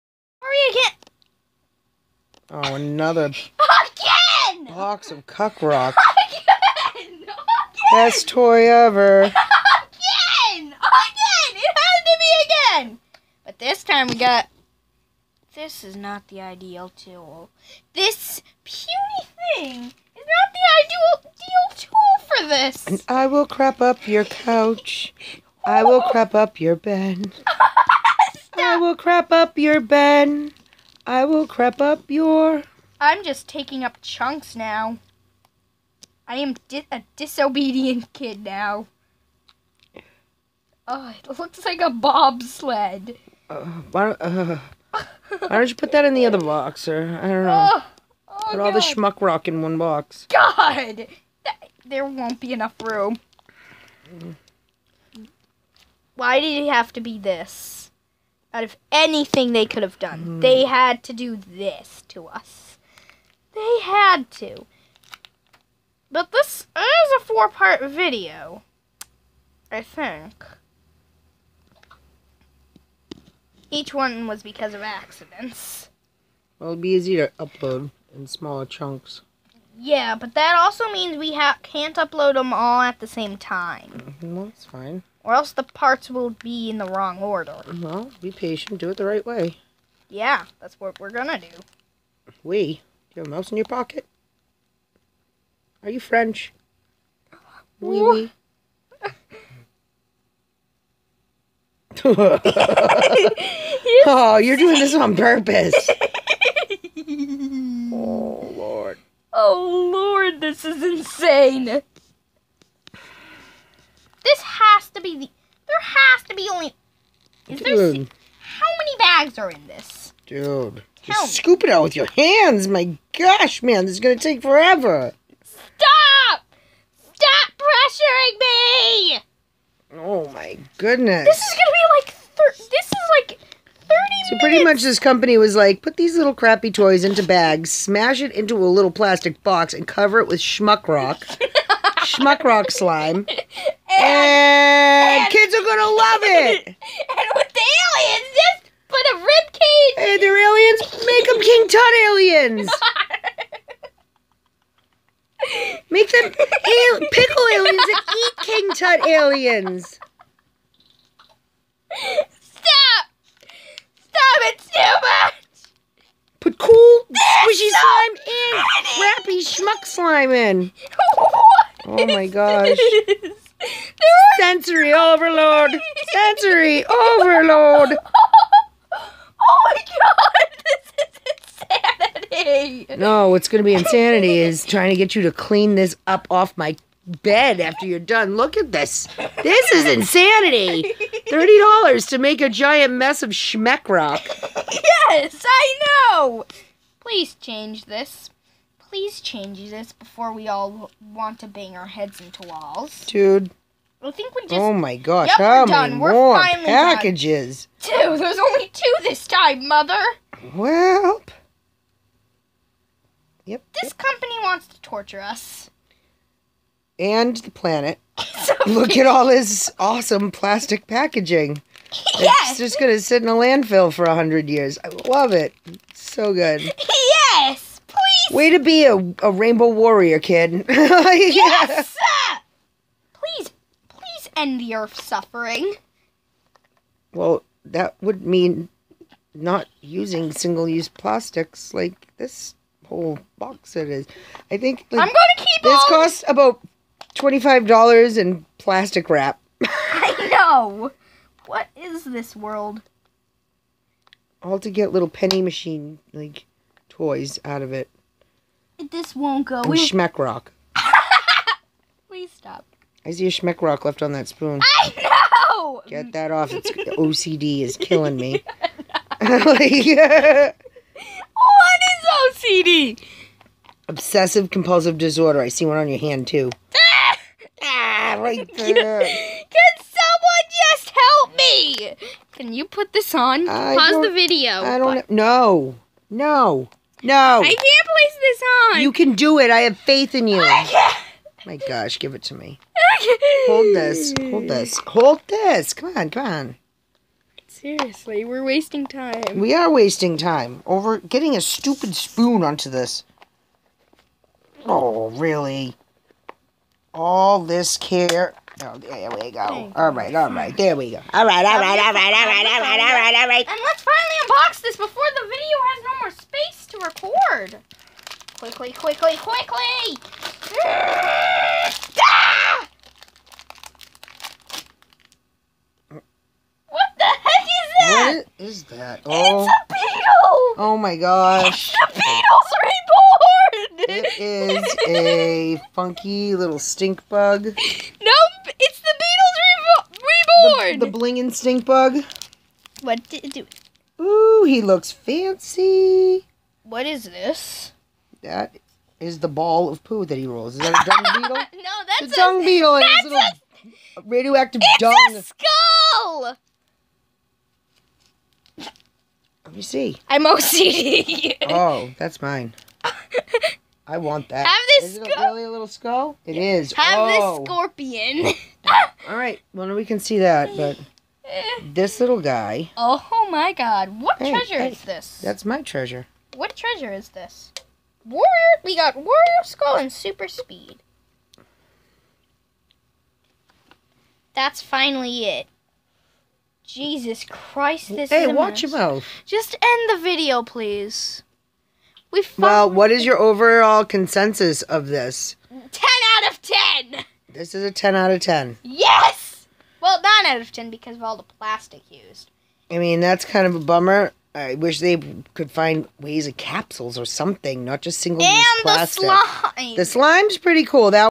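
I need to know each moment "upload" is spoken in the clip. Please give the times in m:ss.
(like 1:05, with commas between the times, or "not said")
1:17, 1:21.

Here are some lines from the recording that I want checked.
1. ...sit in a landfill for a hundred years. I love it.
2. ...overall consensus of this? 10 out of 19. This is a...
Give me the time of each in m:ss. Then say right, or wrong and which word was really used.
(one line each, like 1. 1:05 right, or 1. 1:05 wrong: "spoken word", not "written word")
1. 3:43 right
2. 6:33 wrong: "10", not "19".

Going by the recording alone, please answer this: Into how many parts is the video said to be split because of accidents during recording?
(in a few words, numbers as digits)
4.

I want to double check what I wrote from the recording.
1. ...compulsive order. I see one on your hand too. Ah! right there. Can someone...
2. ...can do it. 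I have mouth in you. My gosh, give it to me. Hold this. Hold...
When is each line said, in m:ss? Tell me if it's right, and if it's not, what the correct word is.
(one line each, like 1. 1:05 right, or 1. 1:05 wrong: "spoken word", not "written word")
1. 4:34 wrong: "disorder", not "order"
2. 4:48 wrong: "faith", not "mouth".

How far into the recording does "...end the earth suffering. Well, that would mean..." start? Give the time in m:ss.
3:54.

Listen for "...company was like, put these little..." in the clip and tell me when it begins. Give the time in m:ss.
2:14.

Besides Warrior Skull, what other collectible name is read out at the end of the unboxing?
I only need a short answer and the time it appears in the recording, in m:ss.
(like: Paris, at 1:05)
Super Speed, at 6:19.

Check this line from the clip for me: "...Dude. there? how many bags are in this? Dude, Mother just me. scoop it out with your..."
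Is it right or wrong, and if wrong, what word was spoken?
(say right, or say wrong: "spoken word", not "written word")
wrong: "Tell", not "Mother".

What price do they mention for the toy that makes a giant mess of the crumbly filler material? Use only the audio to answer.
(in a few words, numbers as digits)
$30.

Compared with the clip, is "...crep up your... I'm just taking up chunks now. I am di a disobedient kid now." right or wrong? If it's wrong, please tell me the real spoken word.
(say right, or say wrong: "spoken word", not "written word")
right.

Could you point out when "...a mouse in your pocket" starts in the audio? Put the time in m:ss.
1:33.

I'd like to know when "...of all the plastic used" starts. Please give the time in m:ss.
6:40.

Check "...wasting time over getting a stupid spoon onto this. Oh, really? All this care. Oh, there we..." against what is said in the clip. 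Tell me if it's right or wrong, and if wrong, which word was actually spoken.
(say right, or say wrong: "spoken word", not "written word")
right.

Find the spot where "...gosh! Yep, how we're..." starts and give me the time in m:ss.
3:24.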